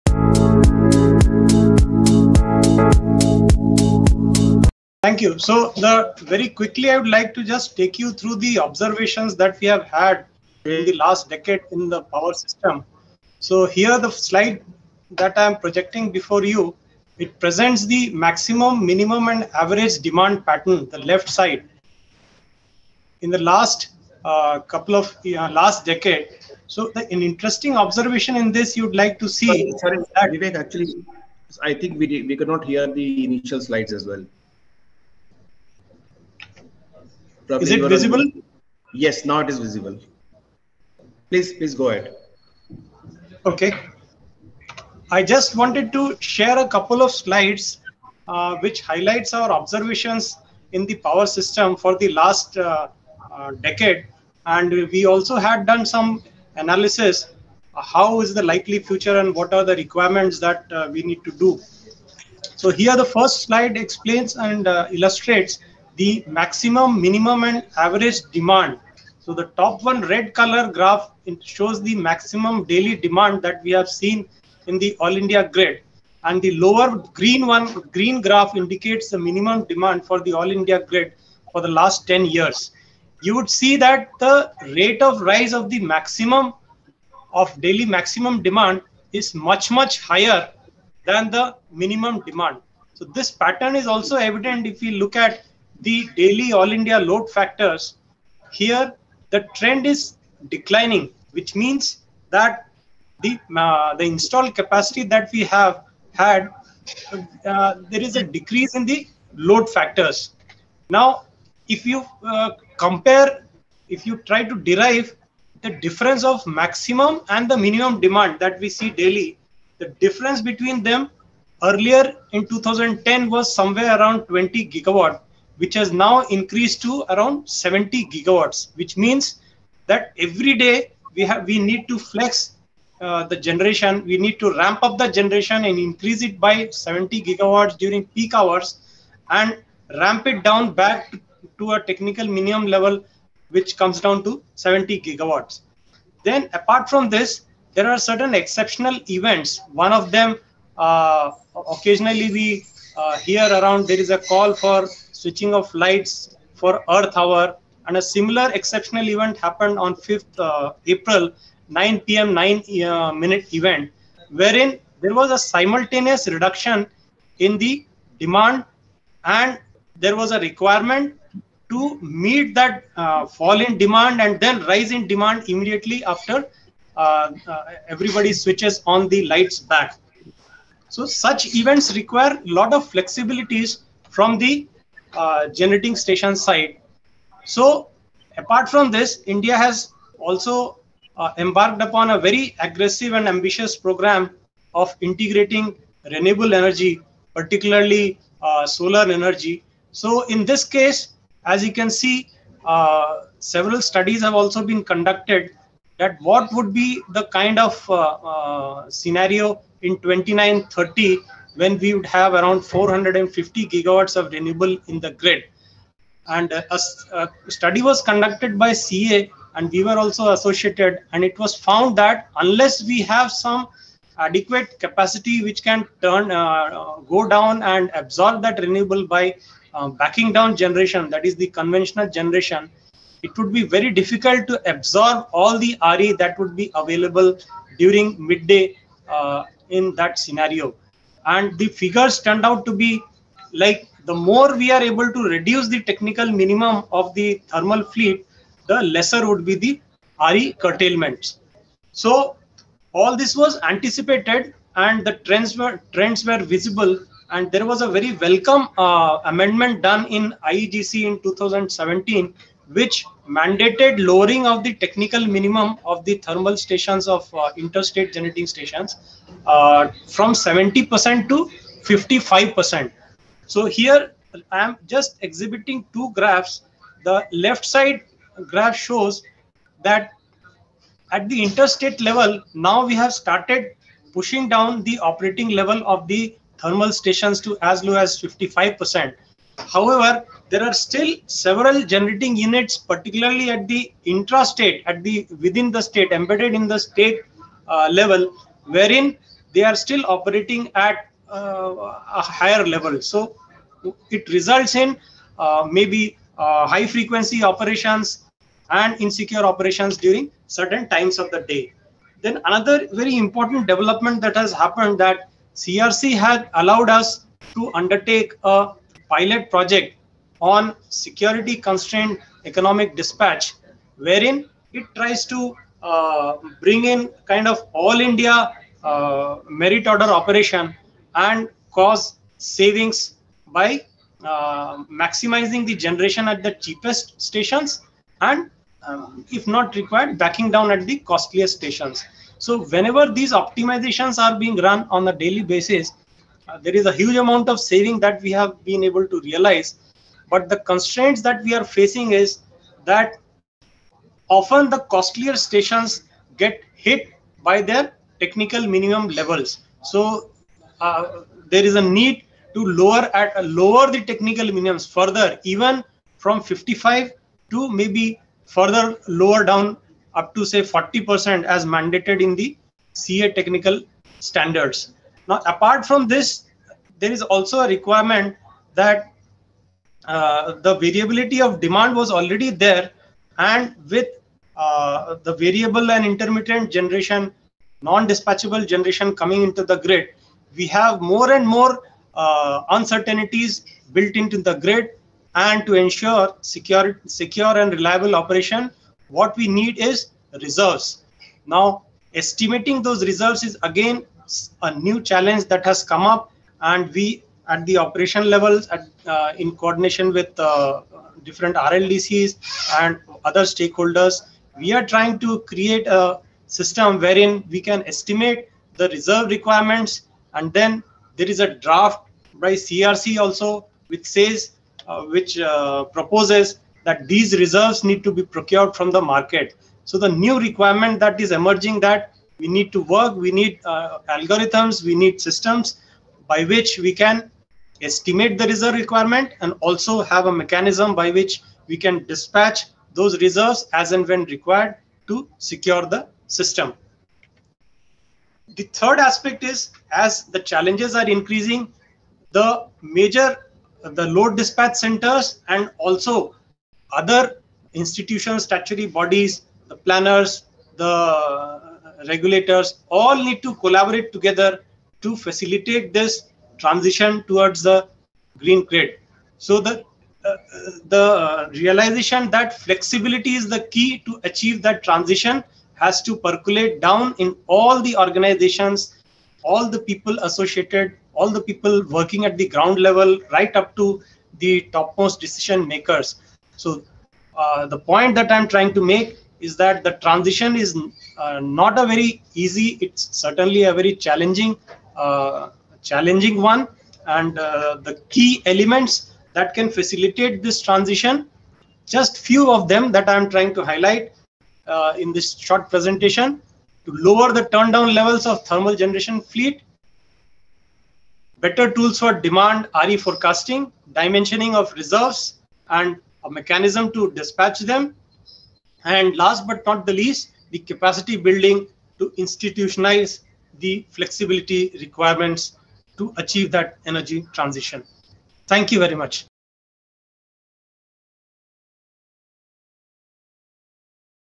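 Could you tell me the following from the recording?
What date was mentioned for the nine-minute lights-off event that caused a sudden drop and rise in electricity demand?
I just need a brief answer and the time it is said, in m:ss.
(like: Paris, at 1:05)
5th April, at 2:39.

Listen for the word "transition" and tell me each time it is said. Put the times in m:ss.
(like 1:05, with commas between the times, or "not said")
7:46, 7:54, 8:10, 8:20, 8:47.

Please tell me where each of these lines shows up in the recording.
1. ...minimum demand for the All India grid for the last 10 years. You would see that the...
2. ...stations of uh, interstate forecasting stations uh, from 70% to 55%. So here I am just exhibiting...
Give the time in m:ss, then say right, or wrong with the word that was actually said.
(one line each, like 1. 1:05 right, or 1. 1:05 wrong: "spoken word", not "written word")
1. 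1:19 right
2. 4:26 wrong: "generating", not "forecasting".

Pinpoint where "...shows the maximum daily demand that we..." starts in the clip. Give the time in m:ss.
1:11.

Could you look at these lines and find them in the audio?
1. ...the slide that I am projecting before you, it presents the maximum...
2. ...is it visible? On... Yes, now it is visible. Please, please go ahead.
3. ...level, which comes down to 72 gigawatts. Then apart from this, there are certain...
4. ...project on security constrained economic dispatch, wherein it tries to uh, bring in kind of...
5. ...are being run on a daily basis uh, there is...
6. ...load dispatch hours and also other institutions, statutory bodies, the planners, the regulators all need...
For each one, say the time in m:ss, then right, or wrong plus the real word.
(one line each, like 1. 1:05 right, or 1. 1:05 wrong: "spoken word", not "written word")
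1. 0:13 right
2. 0:37 right
3. 2:22 wrong: "70", not "72"
4. 5:19 right
5. 5:44 right
6. 7:34 wrong: "centers", not "hours".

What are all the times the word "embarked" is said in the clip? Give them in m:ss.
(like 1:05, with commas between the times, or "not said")
3:11.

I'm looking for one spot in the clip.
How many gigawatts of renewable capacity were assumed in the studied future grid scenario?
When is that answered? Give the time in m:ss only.
3:32.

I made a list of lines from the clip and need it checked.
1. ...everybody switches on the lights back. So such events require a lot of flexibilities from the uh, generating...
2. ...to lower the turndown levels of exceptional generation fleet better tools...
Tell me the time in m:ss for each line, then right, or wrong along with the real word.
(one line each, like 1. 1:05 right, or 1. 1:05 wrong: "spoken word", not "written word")
1. 2:57 right
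2. 8:26 wrong: "thermal", not "exceptional".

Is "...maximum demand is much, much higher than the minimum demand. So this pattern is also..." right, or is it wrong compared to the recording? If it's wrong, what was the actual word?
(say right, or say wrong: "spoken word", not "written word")
right.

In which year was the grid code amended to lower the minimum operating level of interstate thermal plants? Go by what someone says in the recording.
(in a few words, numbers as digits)
2017.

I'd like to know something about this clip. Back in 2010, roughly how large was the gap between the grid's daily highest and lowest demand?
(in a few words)
20 gigawatts.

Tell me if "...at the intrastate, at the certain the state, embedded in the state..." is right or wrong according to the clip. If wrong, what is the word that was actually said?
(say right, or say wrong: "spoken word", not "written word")
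wrong: "within", not "certain".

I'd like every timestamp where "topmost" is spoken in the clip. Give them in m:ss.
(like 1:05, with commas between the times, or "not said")
8:04.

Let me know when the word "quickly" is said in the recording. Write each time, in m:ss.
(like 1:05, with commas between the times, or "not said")
0:06.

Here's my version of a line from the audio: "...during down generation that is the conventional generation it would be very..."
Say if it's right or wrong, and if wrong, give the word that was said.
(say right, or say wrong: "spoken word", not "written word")
wrong: "backing", not "during".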